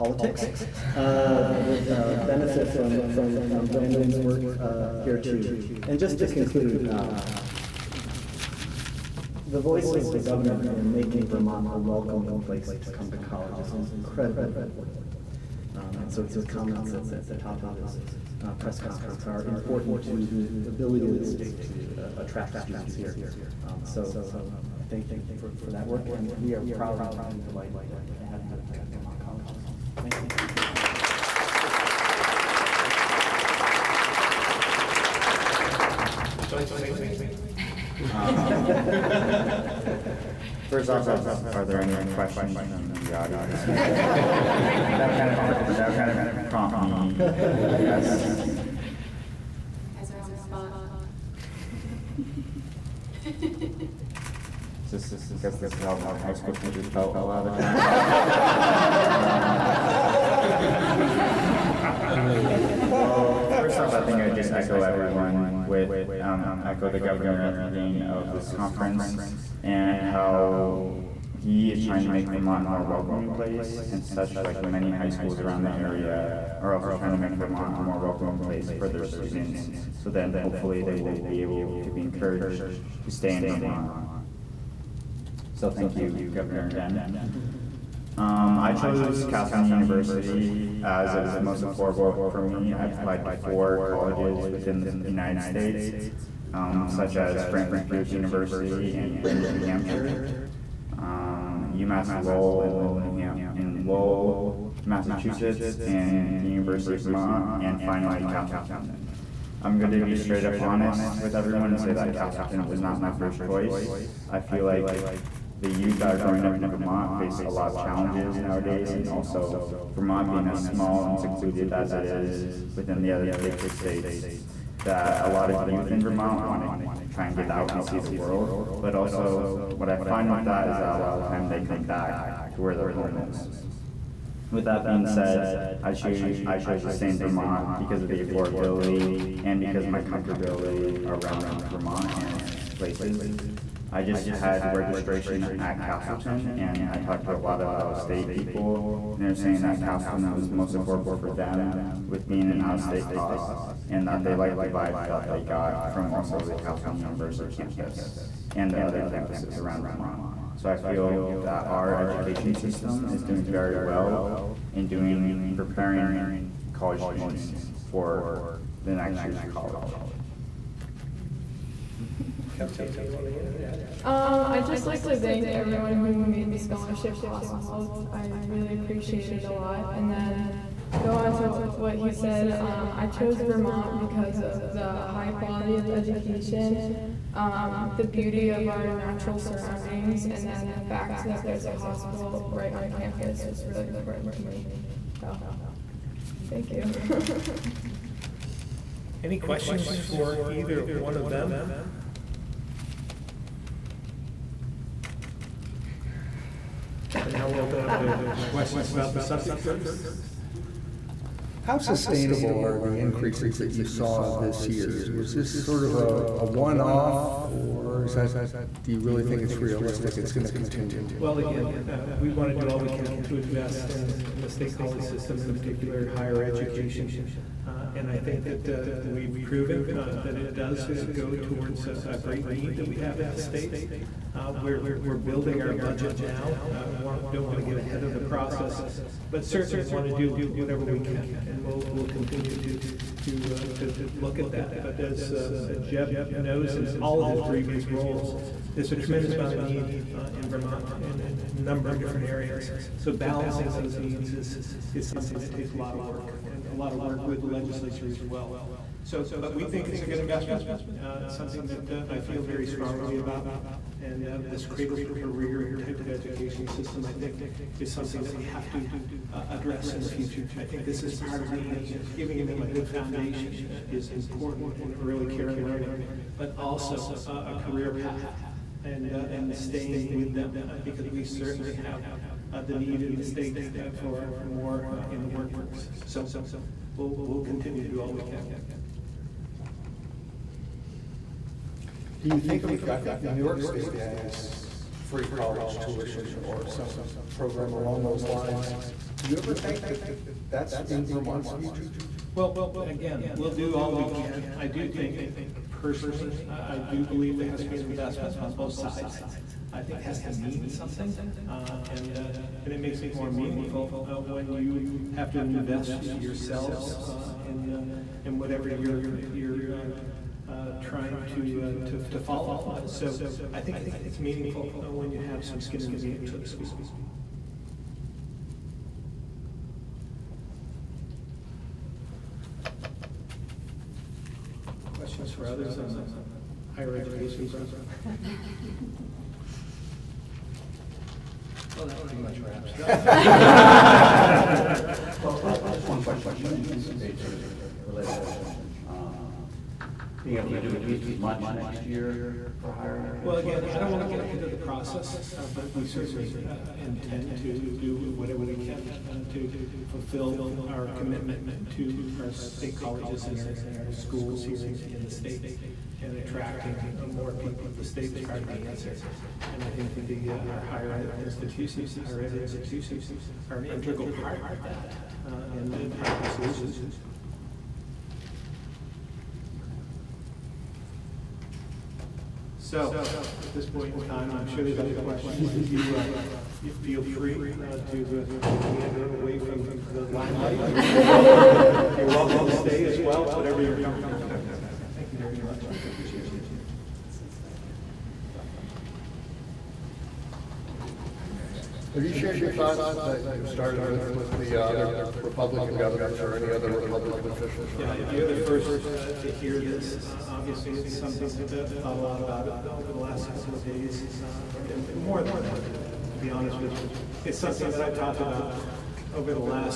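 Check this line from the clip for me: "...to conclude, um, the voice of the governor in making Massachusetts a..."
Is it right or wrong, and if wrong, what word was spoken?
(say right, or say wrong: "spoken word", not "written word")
wrong: "Vermont", not "Massachusetts".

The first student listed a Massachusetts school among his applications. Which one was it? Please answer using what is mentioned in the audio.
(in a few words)
UMass Lowell.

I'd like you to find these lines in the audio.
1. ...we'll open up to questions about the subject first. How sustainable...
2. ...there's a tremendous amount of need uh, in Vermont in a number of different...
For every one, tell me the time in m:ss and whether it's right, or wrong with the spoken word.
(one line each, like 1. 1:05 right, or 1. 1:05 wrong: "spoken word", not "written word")
1. 3:27 right
2. 4:08 right.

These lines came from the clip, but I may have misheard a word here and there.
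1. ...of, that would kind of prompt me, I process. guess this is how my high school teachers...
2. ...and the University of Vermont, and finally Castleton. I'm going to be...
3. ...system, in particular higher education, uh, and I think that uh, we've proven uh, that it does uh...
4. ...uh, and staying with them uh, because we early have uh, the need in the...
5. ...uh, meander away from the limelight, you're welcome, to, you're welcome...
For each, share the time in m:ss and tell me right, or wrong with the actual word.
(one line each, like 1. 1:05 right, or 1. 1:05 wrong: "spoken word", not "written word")
1. 0:45 wrong: "guess", not "process"
2. 1:45 right
3. 3:45 right
4. 4:39 wrong: "certainly", not "early"
5. 6:28 right.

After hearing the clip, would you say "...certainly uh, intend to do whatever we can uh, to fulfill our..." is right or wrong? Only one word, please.
right.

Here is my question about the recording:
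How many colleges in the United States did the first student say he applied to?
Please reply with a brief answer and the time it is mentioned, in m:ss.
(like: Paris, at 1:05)
4, at 1:33.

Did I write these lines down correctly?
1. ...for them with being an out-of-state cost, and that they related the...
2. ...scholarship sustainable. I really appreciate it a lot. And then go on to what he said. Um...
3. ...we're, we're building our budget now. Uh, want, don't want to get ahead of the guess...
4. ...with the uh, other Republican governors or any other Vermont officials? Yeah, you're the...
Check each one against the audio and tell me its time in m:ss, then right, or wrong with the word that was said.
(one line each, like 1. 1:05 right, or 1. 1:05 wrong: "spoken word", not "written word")
1. 2:31 wrong: "liked", not "related"
2. 2:56 wrong: "possible", not "sustainable"
3. 3:54 wrong: "process", not "guess"
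4. 6:44 wrong: "Republican", not "Vermont".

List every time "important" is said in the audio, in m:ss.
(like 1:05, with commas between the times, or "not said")
0:14, 0:19, 3:13, 4:34.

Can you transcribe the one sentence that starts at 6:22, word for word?
So at this point in time, I'm sure there's other questions.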